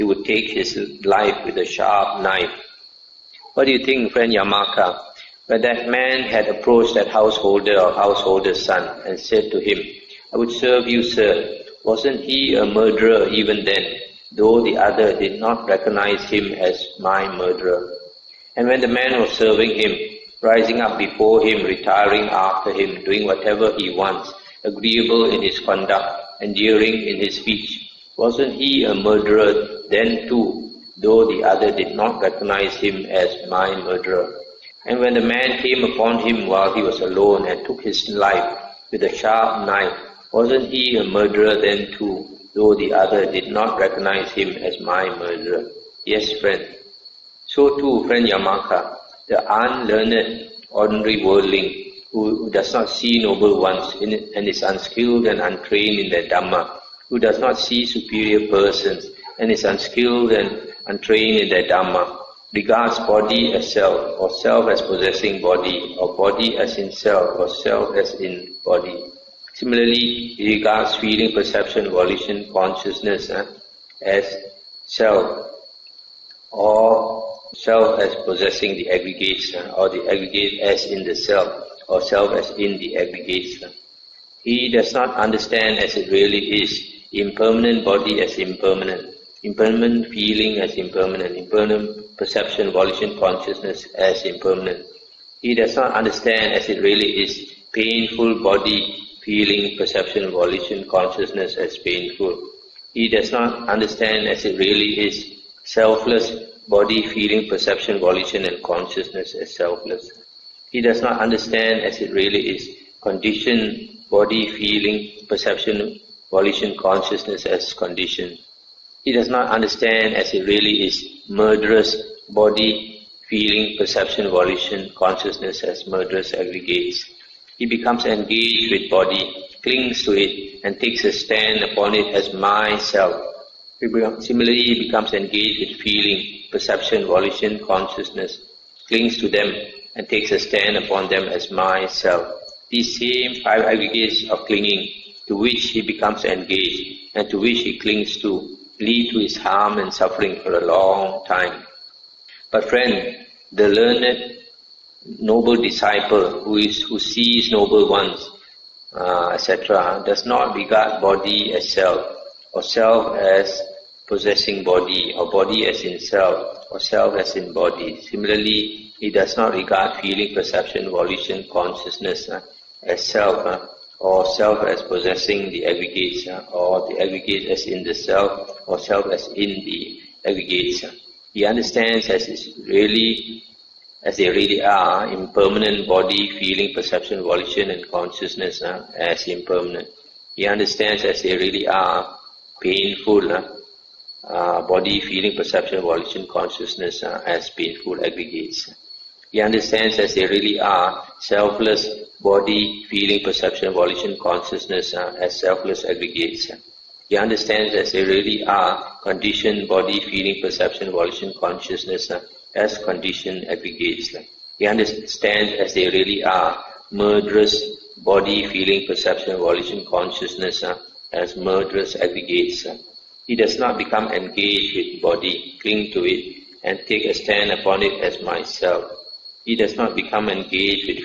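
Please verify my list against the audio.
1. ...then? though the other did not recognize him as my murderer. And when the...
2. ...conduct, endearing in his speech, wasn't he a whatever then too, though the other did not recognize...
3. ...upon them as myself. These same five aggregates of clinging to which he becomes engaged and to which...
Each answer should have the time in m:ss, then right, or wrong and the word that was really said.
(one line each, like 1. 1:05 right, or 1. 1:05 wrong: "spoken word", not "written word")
1. 0:13 right
2. 0:25 wrong: "murderer", not "whatever"
3. 2:20 right.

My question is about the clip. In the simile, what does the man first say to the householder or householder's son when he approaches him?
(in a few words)
I would serve you.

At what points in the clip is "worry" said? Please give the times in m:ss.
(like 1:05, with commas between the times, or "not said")
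not said.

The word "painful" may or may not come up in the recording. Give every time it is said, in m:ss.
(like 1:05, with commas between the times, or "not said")
1:37, 1:41, 3:12, 3:17.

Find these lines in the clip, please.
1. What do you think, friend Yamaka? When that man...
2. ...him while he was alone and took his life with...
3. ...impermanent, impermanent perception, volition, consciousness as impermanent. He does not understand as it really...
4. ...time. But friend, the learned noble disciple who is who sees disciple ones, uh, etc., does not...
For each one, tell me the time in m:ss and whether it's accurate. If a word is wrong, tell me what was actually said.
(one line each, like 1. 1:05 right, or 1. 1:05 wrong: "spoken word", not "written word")
1. 0:03 right
2. 0:36 right
3. 1:30 right
4. 2:31 wrong: "noble", not "disciple".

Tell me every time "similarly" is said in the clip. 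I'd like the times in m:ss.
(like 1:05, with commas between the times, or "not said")
1:09, 2:14, 2:48.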